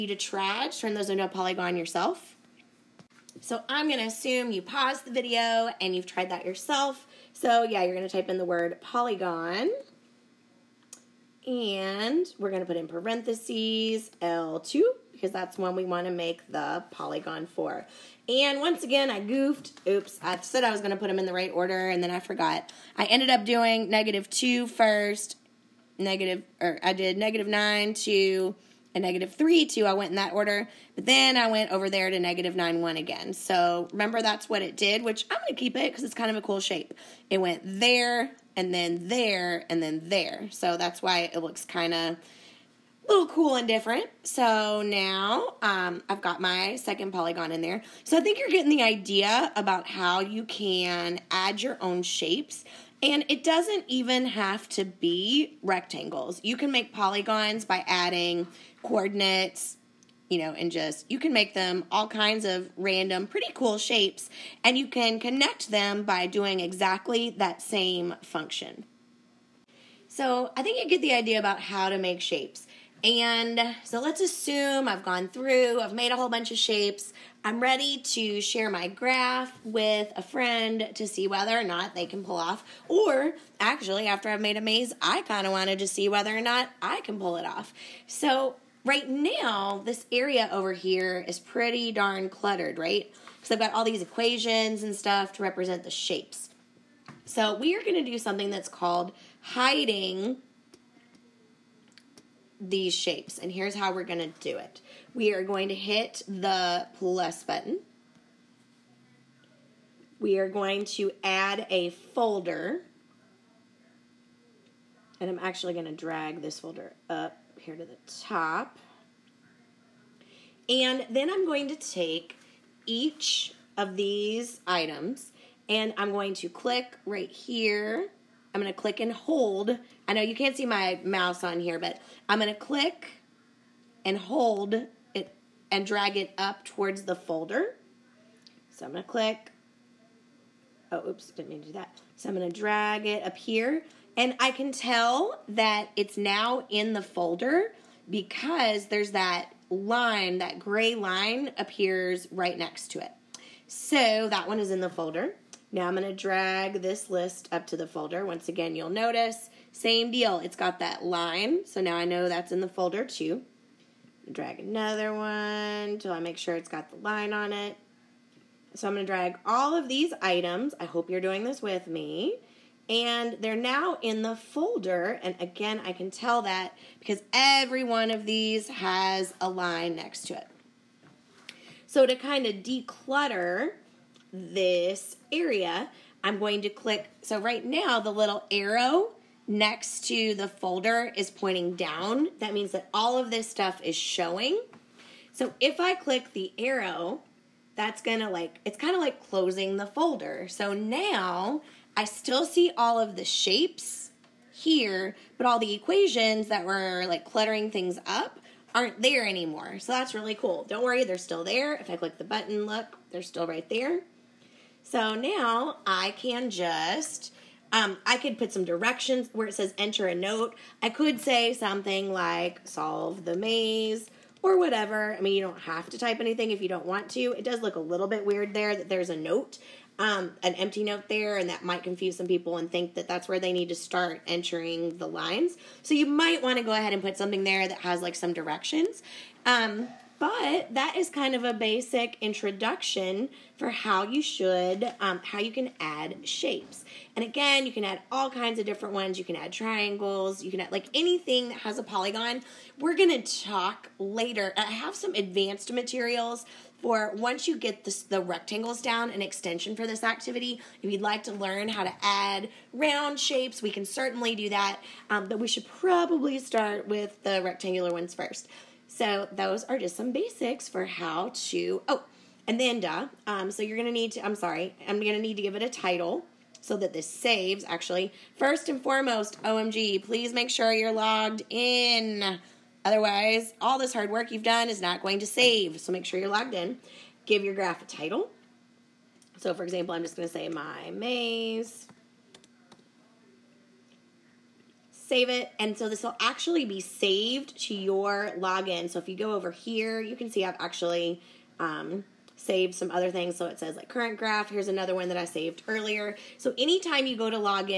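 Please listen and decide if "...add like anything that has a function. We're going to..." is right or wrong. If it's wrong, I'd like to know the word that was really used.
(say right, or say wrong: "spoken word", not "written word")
wrong: "polygon", not "function".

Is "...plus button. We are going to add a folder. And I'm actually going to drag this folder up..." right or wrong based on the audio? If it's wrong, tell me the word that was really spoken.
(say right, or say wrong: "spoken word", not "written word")
right.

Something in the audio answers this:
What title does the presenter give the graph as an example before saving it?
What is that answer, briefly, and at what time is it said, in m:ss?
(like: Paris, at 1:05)
My maze, at 4:50.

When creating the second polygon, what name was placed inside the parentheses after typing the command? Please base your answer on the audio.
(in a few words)
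L2.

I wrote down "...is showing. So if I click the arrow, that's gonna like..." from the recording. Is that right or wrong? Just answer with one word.
right.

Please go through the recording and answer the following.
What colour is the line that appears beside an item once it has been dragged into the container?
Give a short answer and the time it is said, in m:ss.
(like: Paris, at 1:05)
Gray, at 2:30.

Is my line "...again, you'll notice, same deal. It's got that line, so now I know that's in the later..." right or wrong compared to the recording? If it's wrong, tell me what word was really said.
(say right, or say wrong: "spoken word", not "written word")
wrong: "folder", not "later".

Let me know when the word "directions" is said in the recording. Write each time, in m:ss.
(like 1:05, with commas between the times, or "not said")
3:38, 3:58.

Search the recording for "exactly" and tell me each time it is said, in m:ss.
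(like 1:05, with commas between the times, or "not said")
1:06.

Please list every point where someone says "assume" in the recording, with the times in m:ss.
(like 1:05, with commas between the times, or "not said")
0:04, 1:14.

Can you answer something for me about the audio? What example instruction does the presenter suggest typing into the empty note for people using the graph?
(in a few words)
Solve the maze.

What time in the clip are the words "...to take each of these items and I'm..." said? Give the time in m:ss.
2:01.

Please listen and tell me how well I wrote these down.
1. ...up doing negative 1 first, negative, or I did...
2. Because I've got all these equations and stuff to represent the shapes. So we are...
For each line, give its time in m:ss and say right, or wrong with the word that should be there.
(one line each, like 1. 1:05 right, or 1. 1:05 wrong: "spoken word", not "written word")
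1. 0:23 wrong: "2", not "1"
2. 1:33 right.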